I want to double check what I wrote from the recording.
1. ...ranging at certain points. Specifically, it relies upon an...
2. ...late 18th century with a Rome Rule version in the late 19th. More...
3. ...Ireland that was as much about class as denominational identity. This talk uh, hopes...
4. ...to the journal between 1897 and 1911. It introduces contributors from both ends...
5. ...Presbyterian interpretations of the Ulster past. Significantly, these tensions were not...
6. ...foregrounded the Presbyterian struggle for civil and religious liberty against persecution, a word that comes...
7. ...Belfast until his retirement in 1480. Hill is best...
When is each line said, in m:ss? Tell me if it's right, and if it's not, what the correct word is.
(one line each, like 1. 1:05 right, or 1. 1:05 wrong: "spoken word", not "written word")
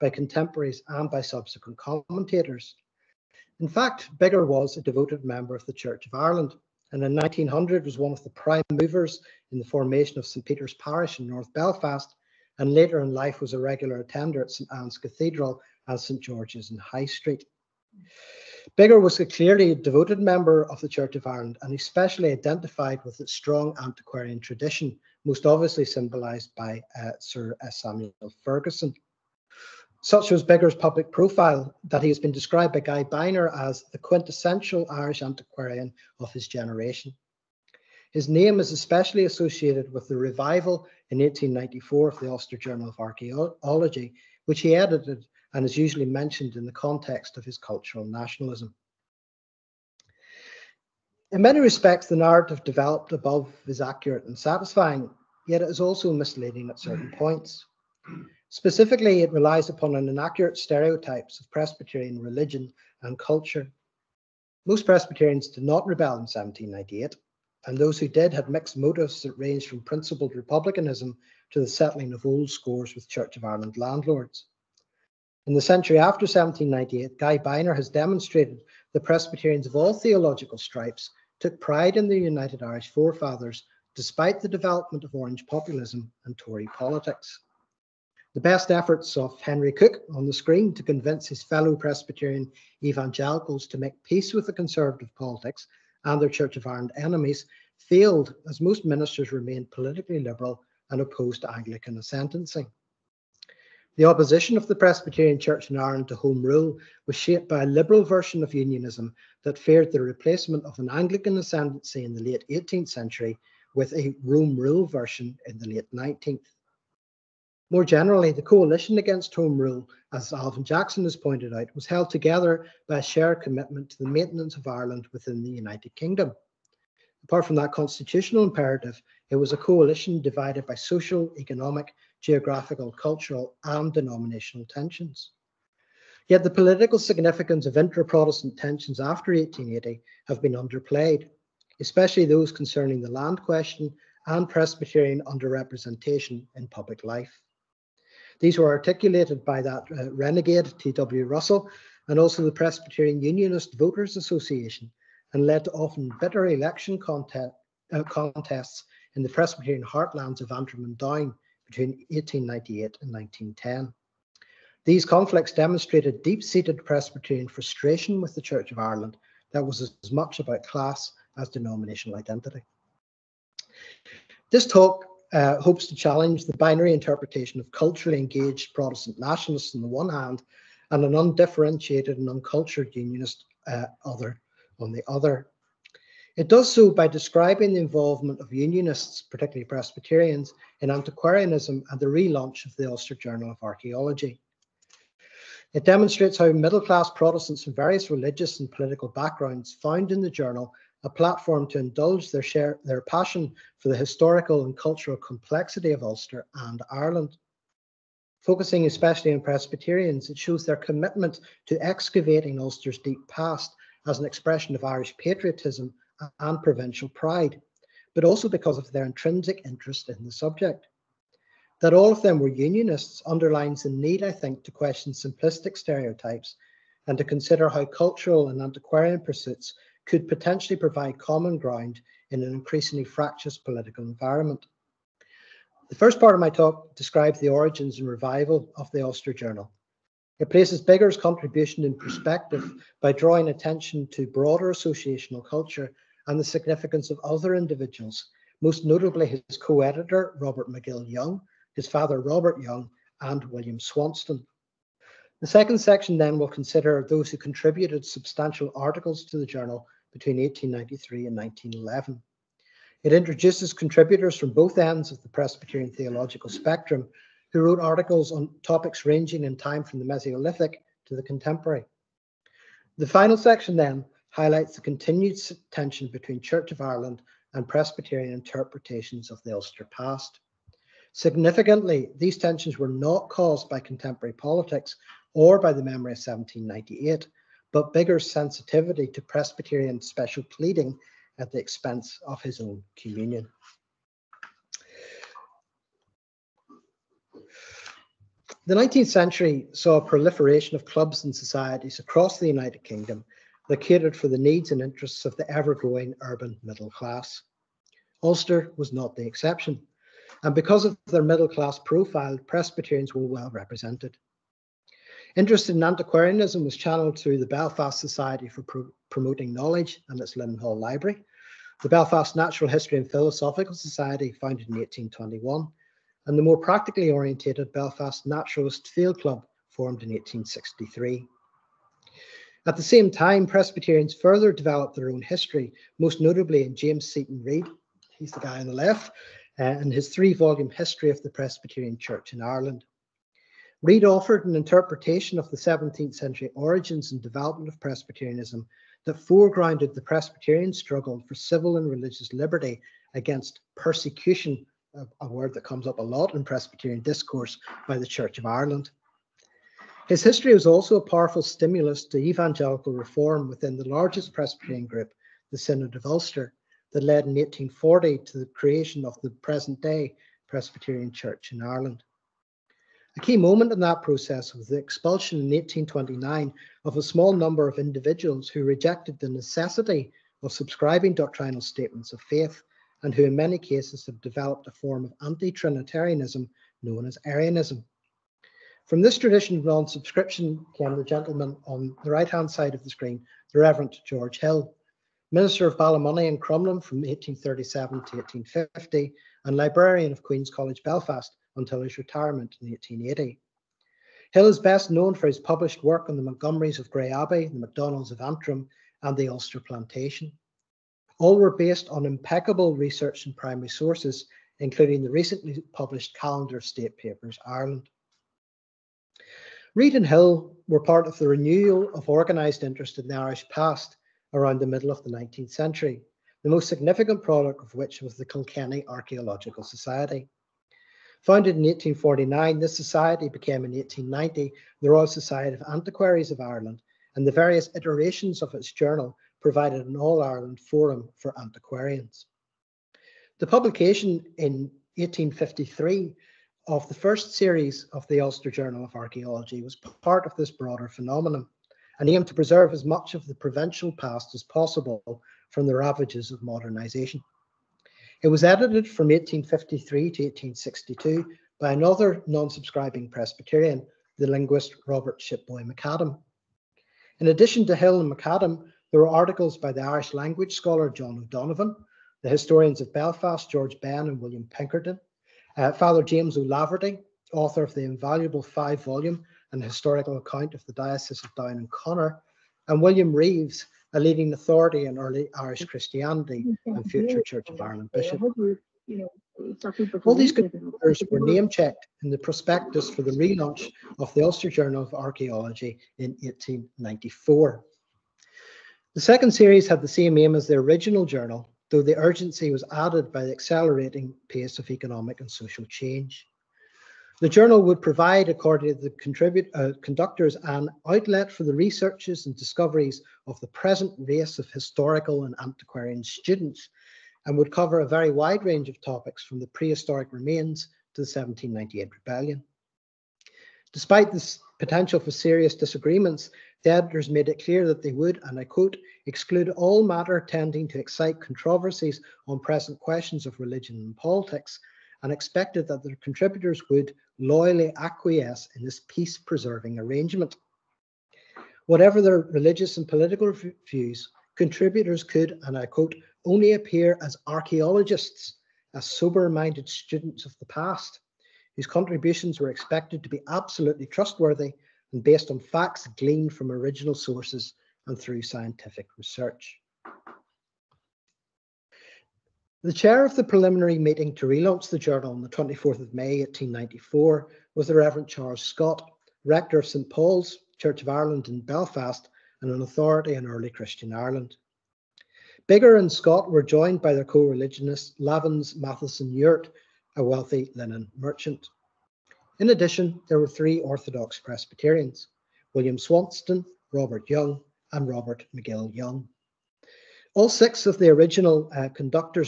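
1. 0:56 wrong: "misleading", not "ranging"
2. 1:52 right
3. 2:48 right
4. 4:19 wrong: "1893", not "1897"
5. 4:37 right
6. 5:49 right
7. 6:40 wrong: "1880", not "1480".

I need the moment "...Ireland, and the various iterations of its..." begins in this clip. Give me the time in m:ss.
7:16.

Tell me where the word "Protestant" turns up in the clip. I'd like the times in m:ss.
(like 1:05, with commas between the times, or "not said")
2:18, 2:58, 3:17.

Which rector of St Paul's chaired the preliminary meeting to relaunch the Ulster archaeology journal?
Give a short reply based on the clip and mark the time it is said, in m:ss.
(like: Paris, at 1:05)
Charles Scott, at 9:28.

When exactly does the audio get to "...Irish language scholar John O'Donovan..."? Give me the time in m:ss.
7:49.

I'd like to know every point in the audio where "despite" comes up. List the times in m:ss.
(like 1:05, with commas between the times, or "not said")
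1:23, 8:43.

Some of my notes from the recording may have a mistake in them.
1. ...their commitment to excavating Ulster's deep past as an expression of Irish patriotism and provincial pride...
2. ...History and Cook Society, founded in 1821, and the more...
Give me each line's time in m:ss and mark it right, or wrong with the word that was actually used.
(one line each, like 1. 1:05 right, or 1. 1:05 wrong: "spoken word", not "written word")
1. 3:30 right
2. 5:22 wrong: "Philosophical", not "Cook".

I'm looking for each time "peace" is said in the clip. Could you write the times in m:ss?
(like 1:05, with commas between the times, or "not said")
1:34, 8:58.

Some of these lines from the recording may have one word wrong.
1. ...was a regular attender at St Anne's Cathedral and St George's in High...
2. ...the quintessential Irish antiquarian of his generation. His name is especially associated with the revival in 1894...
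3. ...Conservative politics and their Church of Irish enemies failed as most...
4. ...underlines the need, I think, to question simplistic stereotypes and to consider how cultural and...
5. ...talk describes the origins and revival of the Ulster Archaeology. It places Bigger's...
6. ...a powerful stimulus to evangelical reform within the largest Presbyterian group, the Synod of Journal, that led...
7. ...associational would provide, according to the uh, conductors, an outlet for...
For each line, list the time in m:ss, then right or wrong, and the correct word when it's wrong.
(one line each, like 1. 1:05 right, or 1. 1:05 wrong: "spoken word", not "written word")
1. 0:13 right
2. 0:33 right
3. 1:34 wrong: "Ireland", not "Irish"
4. 3:43 right
5. 3:56 wrong: "Journal", not "Archaeology"
6. 6:00 wrong: "Ulster", not "Journal"
7. 8:27 wrong: "journal", not "associational".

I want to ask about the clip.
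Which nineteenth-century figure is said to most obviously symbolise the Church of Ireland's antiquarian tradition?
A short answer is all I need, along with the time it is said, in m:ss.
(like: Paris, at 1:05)
Sir Samuel Ferguson, at 0:27.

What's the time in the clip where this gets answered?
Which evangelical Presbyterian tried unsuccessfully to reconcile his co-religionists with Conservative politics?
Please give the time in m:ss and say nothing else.
1:29.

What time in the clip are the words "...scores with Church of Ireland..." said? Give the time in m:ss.
1:12.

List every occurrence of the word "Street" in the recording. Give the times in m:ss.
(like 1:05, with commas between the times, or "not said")
0:17.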